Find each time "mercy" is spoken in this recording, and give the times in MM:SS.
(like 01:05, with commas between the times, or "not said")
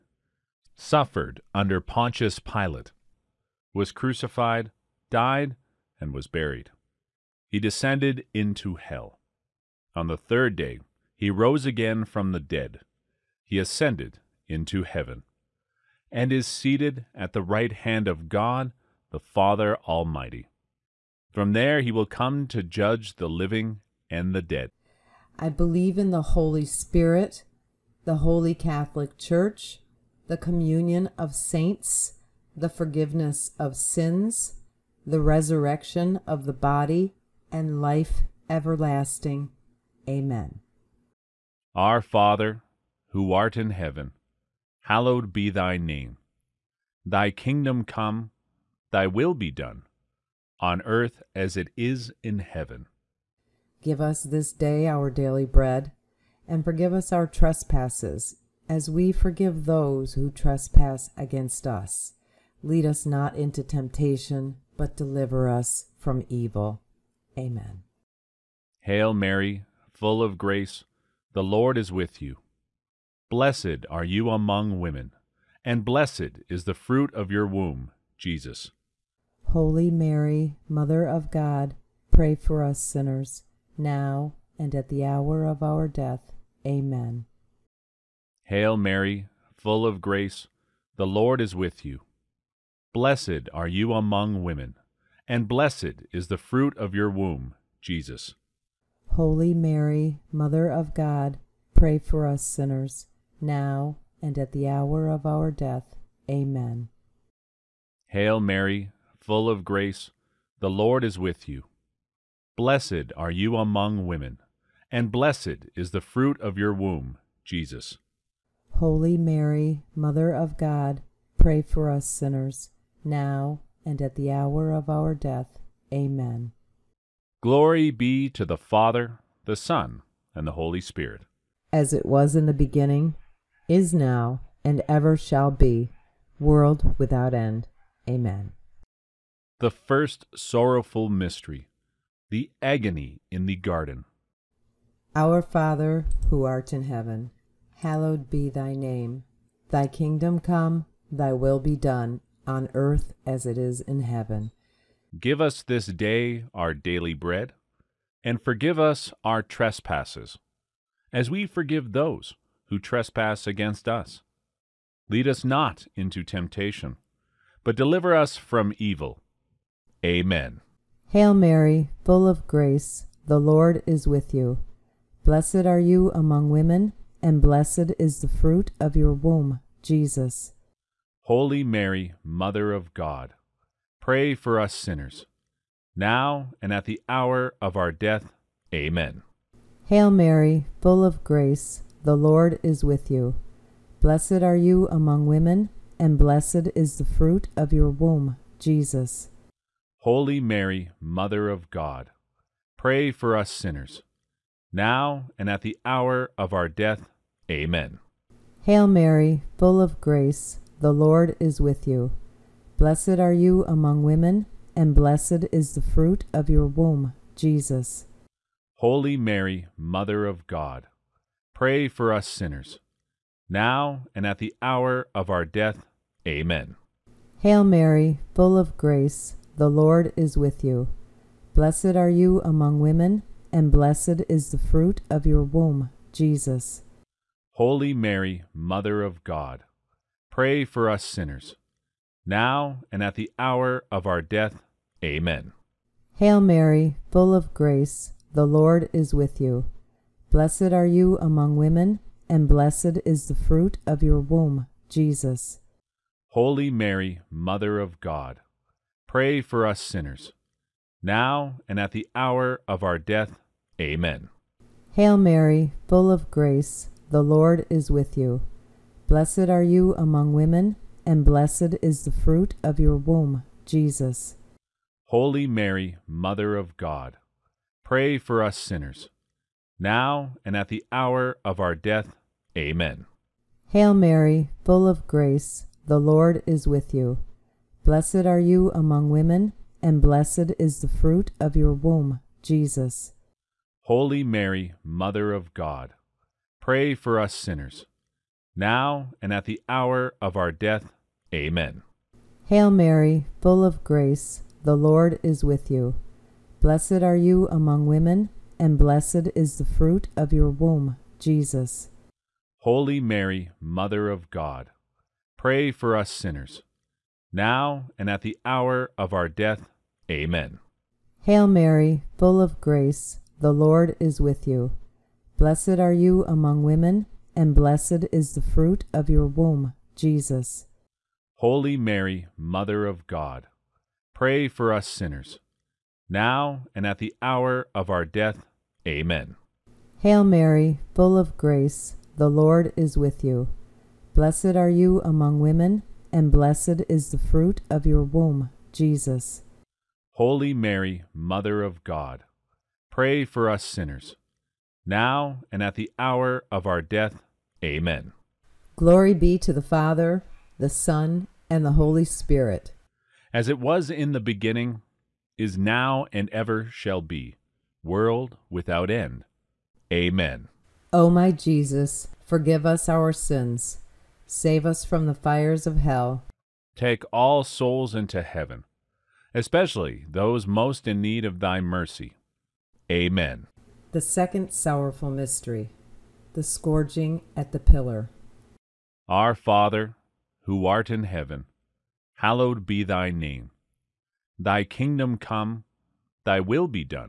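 06:21.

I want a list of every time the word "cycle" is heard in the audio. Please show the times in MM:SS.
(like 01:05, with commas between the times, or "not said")
not said.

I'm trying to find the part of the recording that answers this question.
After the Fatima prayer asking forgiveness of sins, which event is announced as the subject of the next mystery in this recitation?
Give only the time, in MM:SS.
06:26.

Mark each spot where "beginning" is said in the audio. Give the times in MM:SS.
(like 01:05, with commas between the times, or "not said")
02:12, 06:04.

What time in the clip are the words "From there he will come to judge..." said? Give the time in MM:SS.
00:21.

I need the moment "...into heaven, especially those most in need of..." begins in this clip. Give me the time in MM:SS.
06:17.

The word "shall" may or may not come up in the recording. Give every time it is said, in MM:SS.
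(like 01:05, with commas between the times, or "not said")
02:15, 06:06.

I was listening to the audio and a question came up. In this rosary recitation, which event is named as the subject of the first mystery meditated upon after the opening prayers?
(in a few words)
The agony in the garden.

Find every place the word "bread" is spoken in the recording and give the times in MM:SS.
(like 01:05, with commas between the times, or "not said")
00:55, 02:37.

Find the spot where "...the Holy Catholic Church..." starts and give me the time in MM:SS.
00:28.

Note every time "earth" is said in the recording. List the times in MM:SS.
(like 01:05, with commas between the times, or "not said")
00:50, 02:32.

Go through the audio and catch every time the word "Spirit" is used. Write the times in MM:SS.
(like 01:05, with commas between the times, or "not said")
00:26, 02:10, 06:02.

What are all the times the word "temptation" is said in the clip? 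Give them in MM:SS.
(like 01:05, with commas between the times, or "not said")
01:03, 02:46.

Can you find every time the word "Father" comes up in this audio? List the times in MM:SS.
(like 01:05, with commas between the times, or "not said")
00:19, 00:42, 02:08, 02:25, 05:59, 06:29.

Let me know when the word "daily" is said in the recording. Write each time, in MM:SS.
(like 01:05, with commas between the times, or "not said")
00:55, 02:36.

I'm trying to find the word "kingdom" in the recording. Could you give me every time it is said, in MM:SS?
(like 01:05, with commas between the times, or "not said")
00:47, 02:29, 06:34.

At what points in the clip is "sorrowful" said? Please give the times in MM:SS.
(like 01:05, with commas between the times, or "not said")
02:20, 06:24.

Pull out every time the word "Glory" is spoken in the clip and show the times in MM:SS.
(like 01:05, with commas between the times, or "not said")
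02:07, 05:58.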